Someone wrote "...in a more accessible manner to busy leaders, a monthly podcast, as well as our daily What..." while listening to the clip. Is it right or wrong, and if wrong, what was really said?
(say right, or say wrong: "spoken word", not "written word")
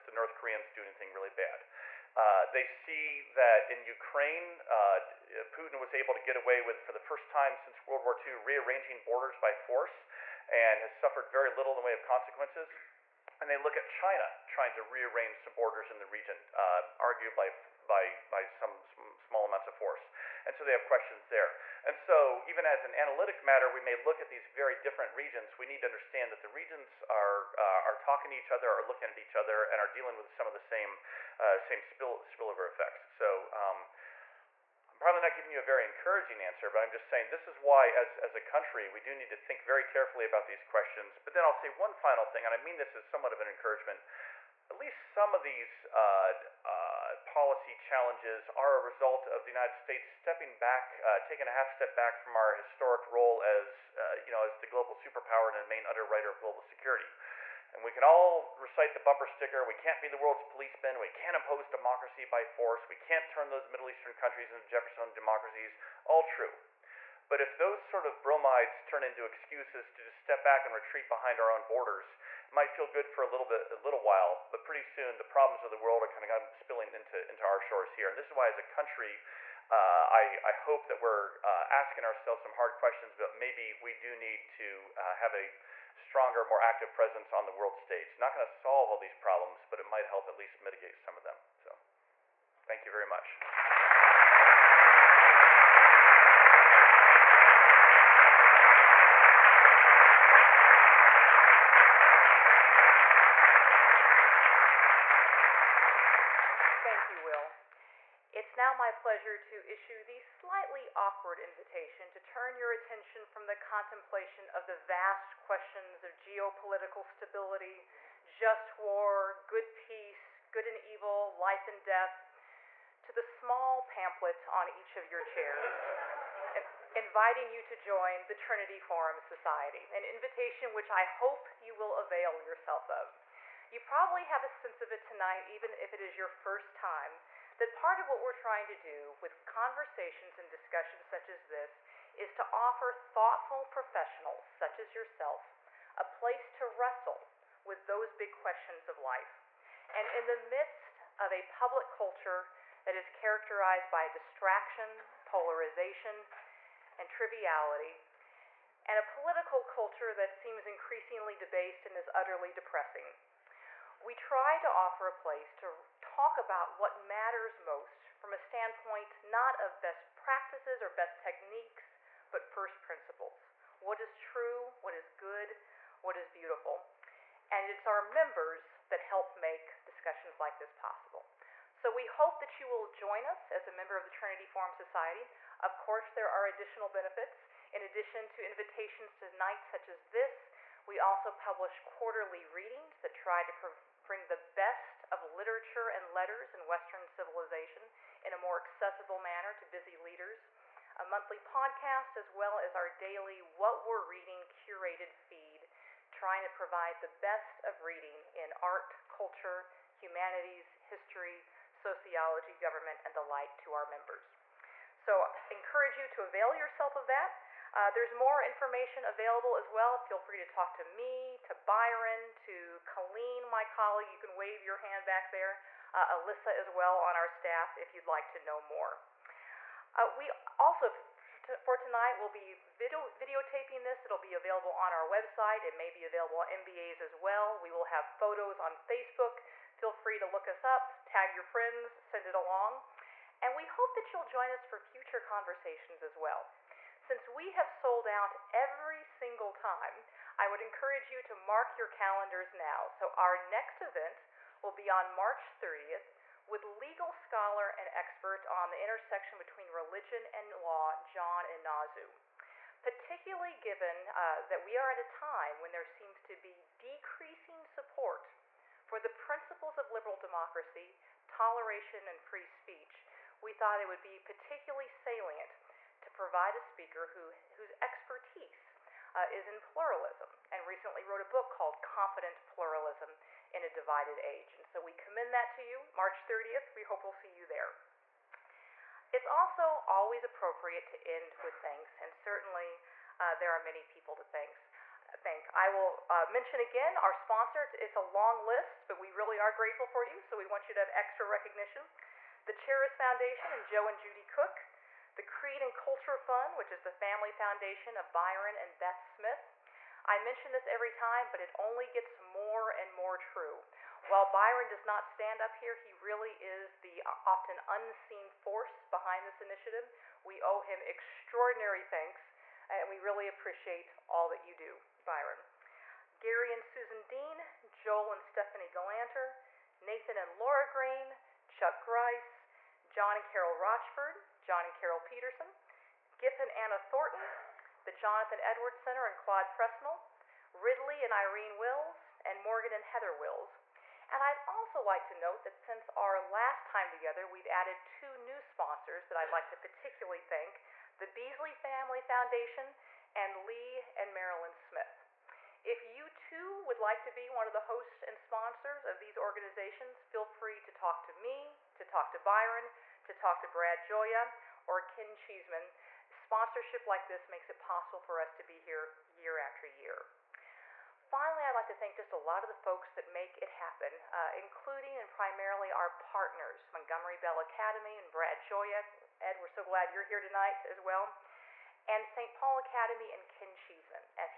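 right.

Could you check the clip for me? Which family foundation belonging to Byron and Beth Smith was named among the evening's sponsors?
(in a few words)
Creed and Culture Fund.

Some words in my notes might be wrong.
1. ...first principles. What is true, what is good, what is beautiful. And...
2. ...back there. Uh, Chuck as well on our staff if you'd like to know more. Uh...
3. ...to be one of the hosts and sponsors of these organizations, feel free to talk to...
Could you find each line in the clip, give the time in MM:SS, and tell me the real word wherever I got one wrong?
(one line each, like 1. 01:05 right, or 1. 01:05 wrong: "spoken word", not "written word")
1. 02:52 right
2. 03:45 wrong: "Alyssa", not "Chuck"
3. 05:57 right.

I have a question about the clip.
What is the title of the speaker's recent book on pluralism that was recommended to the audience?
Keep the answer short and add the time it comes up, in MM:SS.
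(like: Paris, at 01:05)
Confident Pluralism, at 04:41.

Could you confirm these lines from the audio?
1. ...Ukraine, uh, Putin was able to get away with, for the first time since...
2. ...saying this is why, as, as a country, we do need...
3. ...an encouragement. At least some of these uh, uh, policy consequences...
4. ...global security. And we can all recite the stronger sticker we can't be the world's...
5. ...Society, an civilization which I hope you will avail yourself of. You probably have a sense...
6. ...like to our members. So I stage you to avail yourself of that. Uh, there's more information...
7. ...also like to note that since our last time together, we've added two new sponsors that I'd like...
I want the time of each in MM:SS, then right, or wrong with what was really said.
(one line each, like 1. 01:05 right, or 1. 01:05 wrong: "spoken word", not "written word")
1. 00:03 right
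2. 00:37 right
3. 00:43 wrong: "challenges", not "consequences"
4. 00:56 wrong: "bumper", not "stronger"
5. 02:09 wrong: "invitation", not "civilization"
6. 03:33 wrong: "encourage", not "stage"
7. 05:44 right.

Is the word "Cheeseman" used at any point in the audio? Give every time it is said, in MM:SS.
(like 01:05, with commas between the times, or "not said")
06:05, 06:23.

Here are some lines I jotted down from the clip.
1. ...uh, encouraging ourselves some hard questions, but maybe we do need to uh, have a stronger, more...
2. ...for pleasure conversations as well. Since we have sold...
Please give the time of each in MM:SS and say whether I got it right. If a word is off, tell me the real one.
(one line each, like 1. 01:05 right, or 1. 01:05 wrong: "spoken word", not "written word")
1. 01:21 wrong: "asking", not "encouraging"
2. 04:04 wrong: "future", not "pleasure".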